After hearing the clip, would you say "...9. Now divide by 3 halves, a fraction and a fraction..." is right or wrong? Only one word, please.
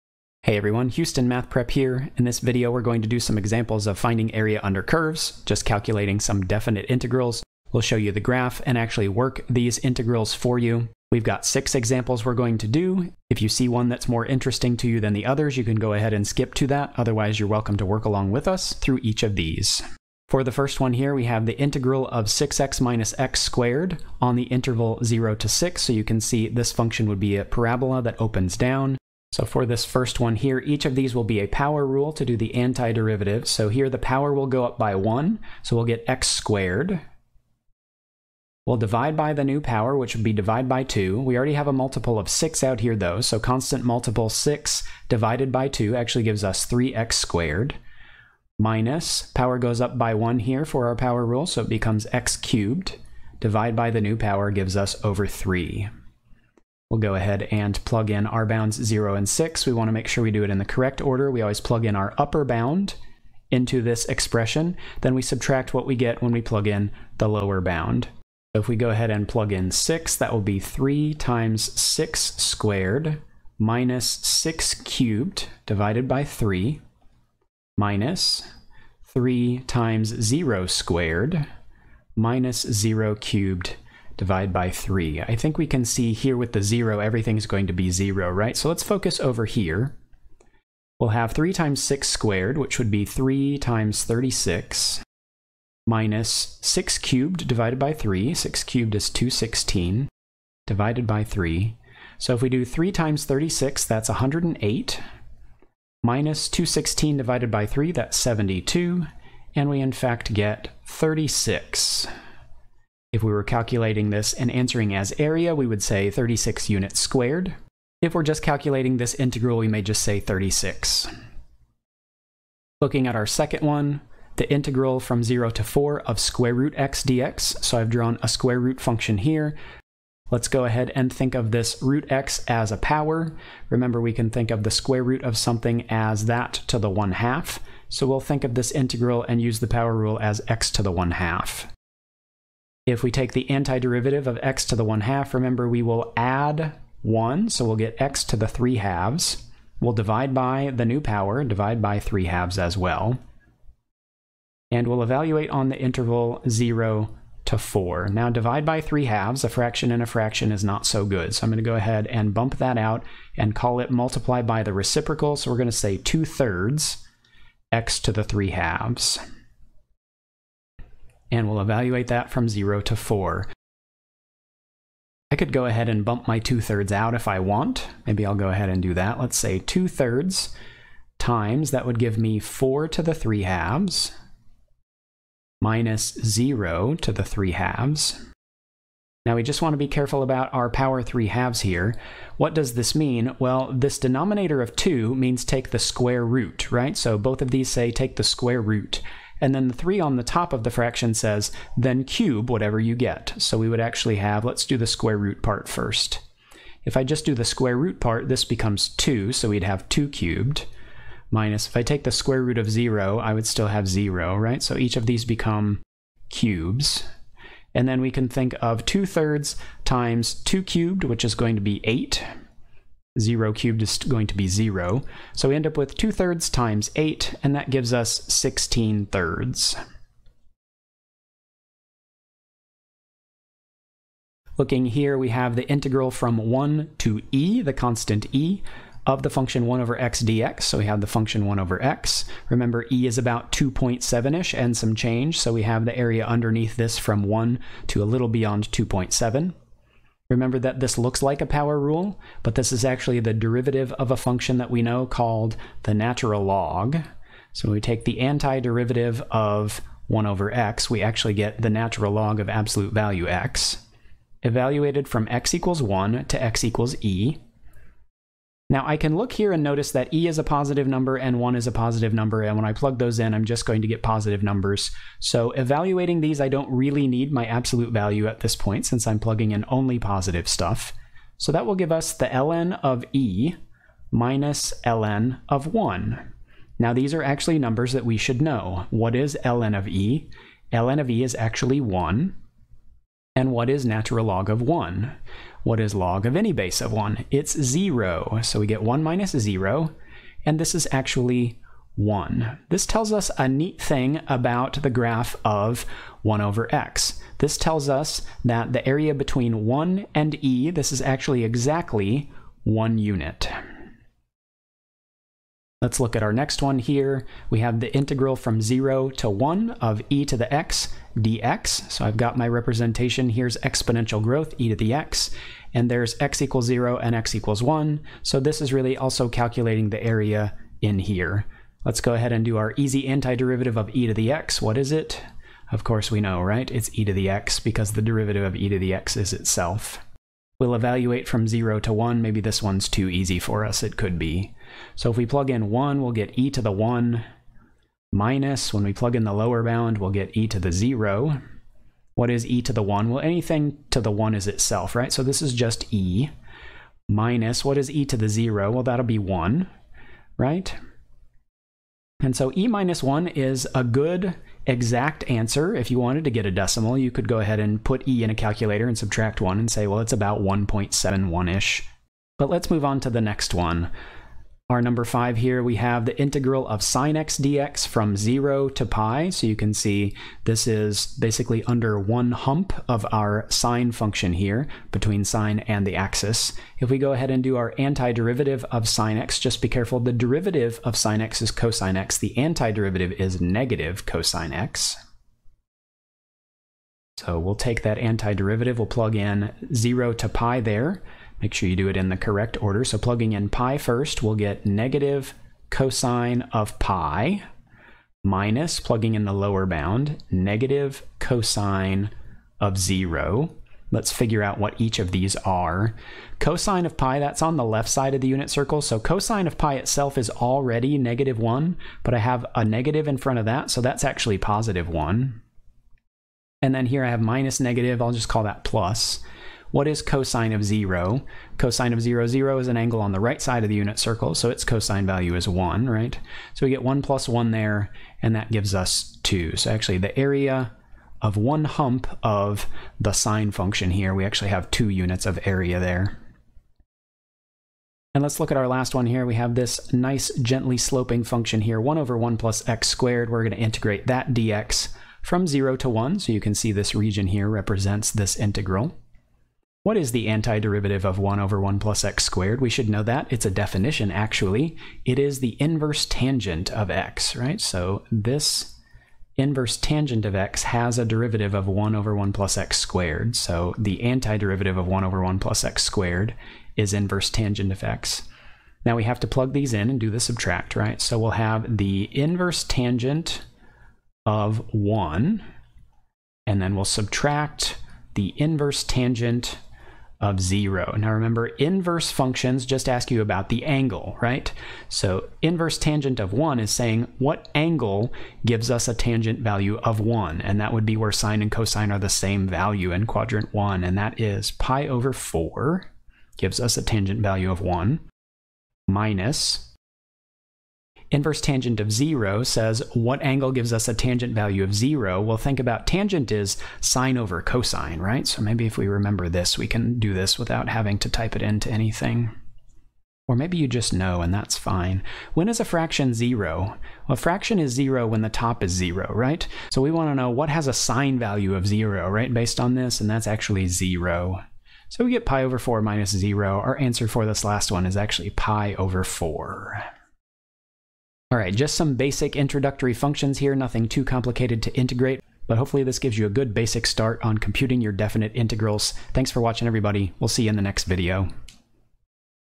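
wrong.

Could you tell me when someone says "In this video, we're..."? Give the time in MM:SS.
00:02.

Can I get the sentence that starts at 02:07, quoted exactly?
So I've drawn a square root function here.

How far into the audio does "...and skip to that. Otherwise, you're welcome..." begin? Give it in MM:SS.
00:16.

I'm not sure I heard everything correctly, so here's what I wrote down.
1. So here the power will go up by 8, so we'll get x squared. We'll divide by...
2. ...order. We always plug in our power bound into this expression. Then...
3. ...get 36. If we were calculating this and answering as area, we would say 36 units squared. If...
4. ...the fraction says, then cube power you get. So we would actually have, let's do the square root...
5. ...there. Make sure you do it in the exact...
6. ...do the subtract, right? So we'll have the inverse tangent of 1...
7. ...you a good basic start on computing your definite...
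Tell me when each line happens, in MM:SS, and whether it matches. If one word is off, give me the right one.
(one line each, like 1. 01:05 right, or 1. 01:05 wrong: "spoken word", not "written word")
1. 00:33 wrong: "1", not "8"
2. 01:00 wrong: "upper", not "power"
3. 01:50 right
4. 03:20 wrong: "whatever", not "power"
5. 06:40 wrong: "correct", not "exact"
6. 07:59 right
7. 09:06 right.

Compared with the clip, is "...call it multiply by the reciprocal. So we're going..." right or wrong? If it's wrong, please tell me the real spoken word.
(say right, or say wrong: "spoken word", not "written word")
right.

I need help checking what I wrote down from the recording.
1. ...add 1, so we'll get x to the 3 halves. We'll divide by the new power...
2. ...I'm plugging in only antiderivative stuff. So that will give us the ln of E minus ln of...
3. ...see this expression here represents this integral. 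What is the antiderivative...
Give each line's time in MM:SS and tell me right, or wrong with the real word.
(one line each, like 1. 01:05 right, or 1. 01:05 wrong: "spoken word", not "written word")
1. 02:26 right
2. 04:39 wrong: "positive", not "antiderivative"
3. 07:36 wrong: "region", not "expression".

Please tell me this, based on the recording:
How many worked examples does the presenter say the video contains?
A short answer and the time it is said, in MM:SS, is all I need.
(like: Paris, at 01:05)
6, at 00:11.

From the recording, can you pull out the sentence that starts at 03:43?
0 cubed is going to be 0.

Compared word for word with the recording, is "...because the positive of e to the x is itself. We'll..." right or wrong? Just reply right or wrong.
wrong.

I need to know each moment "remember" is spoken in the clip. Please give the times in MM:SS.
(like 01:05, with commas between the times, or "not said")
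02:13, 02:25, 04:02, 04:10, 08:11, 08:38.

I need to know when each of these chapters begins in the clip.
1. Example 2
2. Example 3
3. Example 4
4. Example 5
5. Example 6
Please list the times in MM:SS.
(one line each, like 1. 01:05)
1. 02:02
2. 03:53
3. 05:15
4. 06:13
5. 07:27.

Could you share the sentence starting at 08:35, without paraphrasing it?
Well, think about tangent is sine over cosine, right?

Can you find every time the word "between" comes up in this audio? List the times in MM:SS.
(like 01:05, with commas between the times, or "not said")
05:09, 06:24.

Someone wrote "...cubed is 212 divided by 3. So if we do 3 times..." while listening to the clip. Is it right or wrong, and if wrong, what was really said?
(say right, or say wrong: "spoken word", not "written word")
wrong: "216", not "212".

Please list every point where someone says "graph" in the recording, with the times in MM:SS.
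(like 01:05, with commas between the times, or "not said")
00:08, 05:04.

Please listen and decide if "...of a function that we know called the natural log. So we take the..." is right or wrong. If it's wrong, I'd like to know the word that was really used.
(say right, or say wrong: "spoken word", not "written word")
right.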